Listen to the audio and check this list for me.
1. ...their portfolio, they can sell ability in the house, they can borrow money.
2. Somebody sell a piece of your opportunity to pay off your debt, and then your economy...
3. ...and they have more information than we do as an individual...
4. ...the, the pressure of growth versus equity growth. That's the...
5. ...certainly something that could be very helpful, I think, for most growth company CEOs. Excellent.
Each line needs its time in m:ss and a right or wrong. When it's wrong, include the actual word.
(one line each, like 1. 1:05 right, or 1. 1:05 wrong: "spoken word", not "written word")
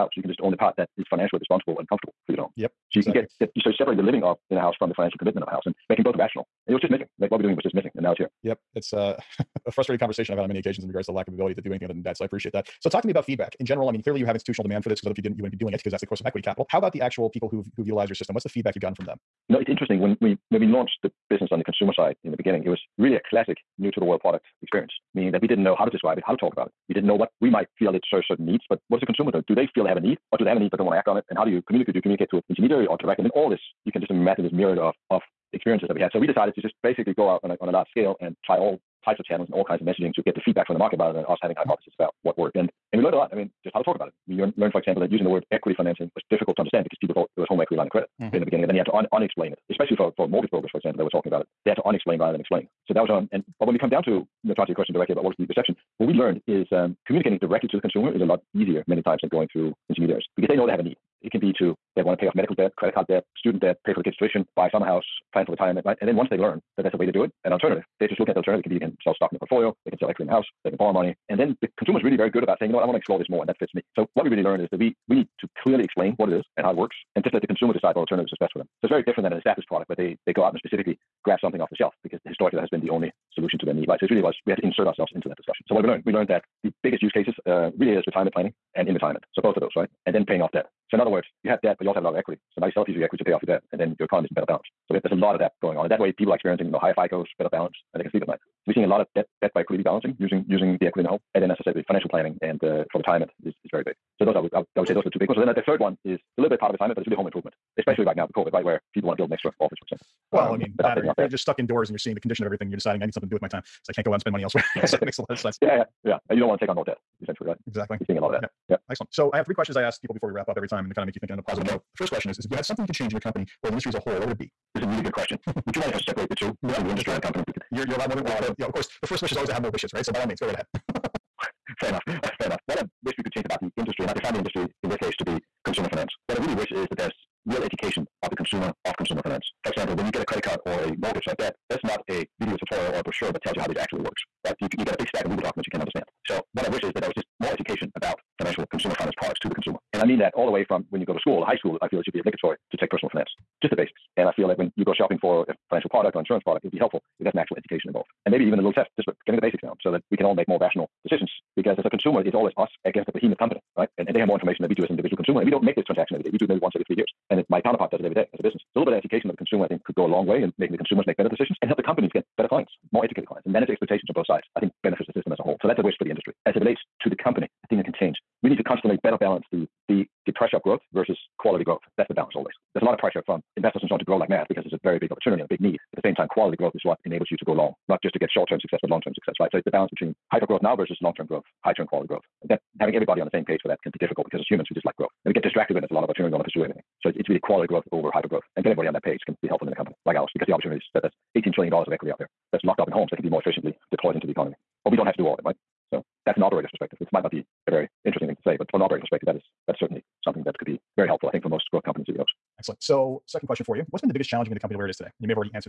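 1. 1:09 wrong: "equity", not "ability"
2. 1:32 wrong: "equity", not "opportunity"
3. 2:44 right
4. 2:59 wrong: "quality", not "equity"
5. 3:29 right.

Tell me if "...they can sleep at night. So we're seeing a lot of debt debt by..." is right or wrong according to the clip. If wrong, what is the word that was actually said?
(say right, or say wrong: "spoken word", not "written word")
right.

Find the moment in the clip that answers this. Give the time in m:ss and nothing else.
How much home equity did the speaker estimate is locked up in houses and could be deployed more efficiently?
3:21.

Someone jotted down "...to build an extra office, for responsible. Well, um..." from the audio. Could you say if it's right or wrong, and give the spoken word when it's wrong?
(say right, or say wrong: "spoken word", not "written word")
wrong: "example", not "responsible".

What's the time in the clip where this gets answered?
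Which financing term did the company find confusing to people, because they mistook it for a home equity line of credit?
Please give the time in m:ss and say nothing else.
0:45.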